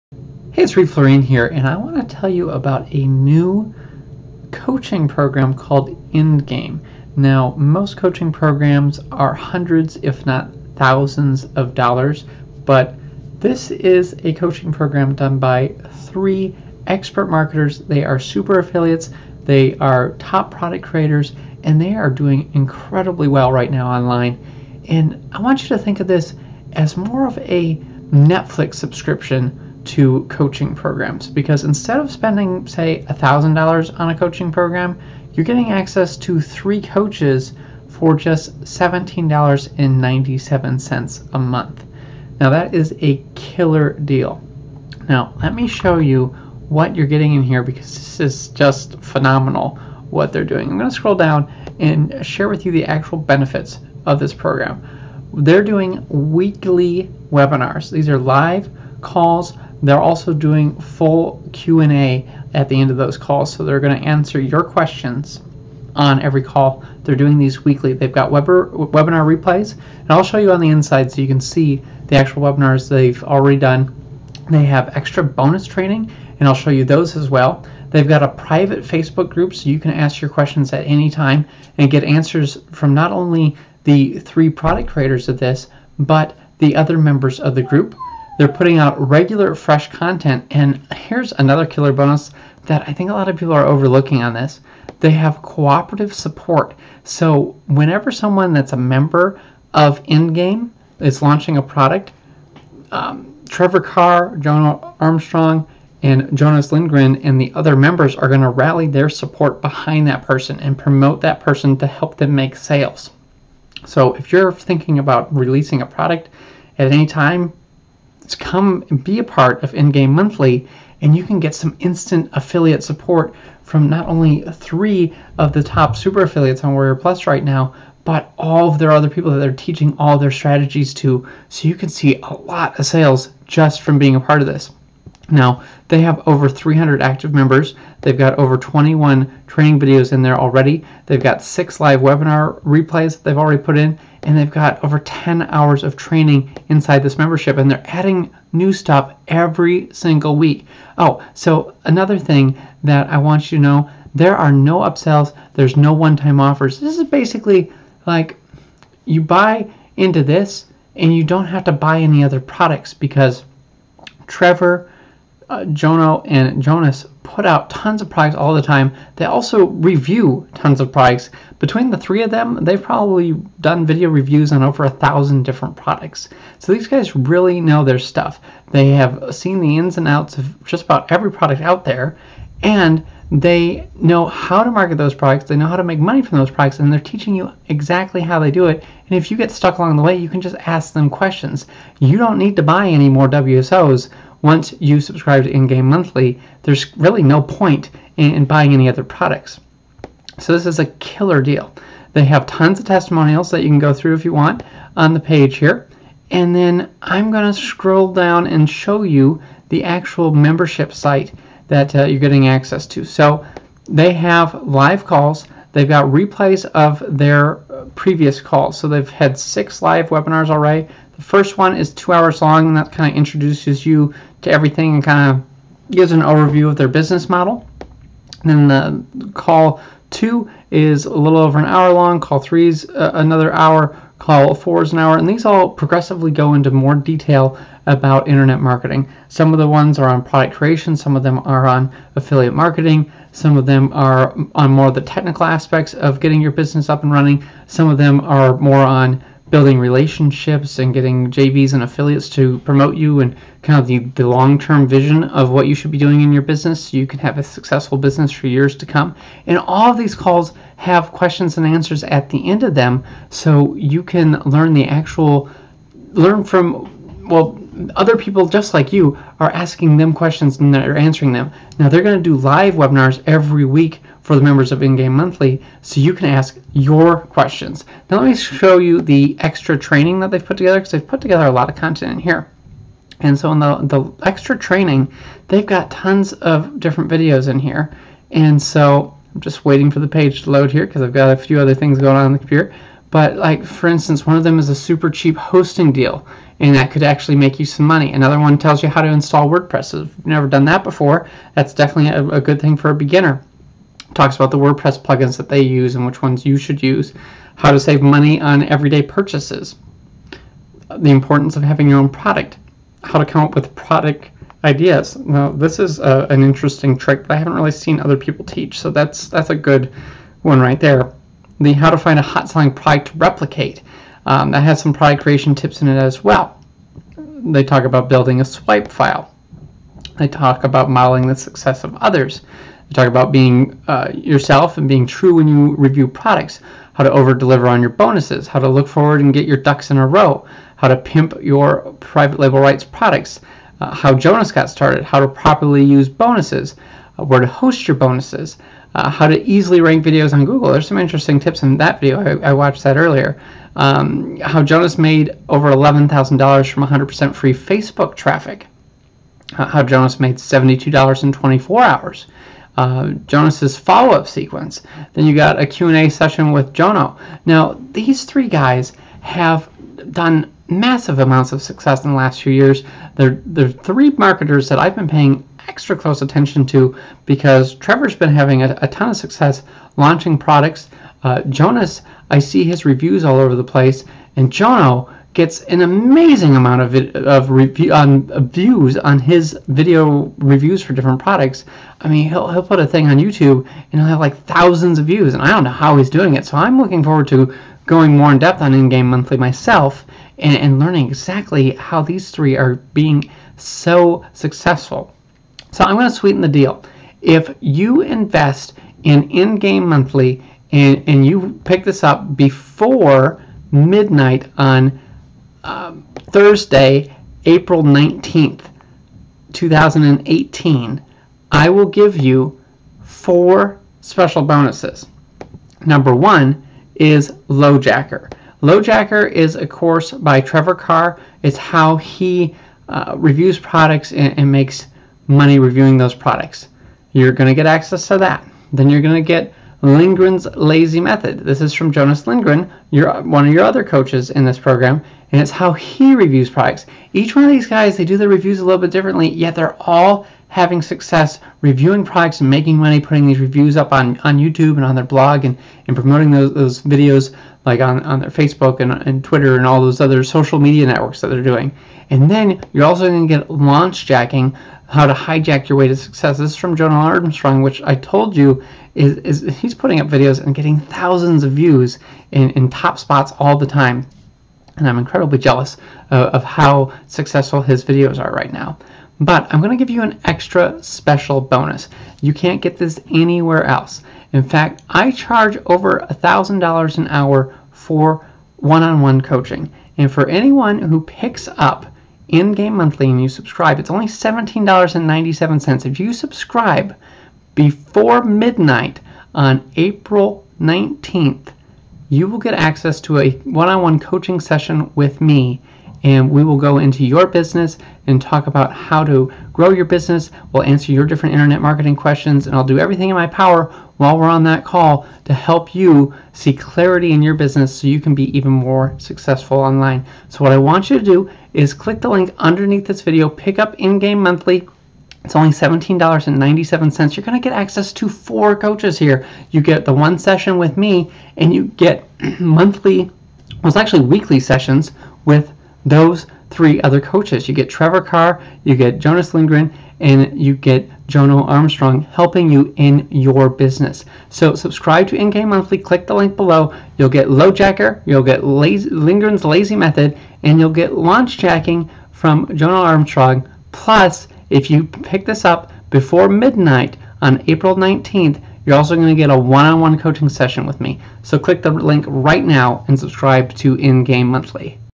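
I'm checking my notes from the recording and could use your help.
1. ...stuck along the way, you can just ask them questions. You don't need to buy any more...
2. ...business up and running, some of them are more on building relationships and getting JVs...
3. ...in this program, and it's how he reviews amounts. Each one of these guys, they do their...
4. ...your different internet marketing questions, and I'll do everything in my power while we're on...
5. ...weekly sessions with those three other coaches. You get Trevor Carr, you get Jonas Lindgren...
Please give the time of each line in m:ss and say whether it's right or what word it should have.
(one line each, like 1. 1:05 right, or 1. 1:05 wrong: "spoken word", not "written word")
1. 3:09 right
2. 4:06 right
3. 7:24 wrong: "products", not "amounts"
4. 8:30 right
5. 8:54 right.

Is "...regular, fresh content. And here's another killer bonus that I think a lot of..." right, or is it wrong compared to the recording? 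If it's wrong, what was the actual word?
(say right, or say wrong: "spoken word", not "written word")
right.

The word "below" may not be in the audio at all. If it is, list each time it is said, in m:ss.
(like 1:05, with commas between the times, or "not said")
9:06.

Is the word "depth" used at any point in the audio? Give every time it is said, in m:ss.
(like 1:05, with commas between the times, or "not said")
6:38.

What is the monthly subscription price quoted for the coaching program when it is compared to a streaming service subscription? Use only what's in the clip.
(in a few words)
$17.97.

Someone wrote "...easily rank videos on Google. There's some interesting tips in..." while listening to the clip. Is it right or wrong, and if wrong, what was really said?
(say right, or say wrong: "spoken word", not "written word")
right.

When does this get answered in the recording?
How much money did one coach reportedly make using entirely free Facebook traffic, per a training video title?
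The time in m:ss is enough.
5:55.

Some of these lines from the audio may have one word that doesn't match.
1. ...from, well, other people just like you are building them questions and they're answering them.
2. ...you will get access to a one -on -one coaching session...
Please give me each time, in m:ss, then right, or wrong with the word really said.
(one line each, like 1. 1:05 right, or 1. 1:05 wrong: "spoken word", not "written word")
1. 4:26 wrong: "asking", not "building"
2. 8:22 right.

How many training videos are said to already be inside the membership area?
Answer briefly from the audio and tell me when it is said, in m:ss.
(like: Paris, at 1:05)
21, at 2:18.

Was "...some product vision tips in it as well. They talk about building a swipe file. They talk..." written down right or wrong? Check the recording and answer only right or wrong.
wrong.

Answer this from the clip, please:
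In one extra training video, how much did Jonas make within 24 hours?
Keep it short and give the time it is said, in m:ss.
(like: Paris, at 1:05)
$72, at 6:00.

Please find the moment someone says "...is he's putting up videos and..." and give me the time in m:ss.
7:49.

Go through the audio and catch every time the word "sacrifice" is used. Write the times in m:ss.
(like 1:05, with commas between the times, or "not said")
not said.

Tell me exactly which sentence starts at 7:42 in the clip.
And then you're also going to get launch jacking, how to hijack your way to success.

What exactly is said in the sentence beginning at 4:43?
And so in the, the extra training, they've got tons of different videos in here.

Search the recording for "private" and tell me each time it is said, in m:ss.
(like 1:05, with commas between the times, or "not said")
1:18, 5:42.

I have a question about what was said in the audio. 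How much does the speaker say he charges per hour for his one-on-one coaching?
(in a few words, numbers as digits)
over $1,000.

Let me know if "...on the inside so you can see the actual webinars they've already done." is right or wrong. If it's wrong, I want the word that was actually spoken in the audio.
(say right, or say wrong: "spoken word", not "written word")
right.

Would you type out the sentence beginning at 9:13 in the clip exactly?
Plus, if you pick this up before midnight on April 19th, you're also going to get a one-on-one coaching session with me.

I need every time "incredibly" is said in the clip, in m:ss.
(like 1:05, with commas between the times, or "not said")
0:22, 7:54.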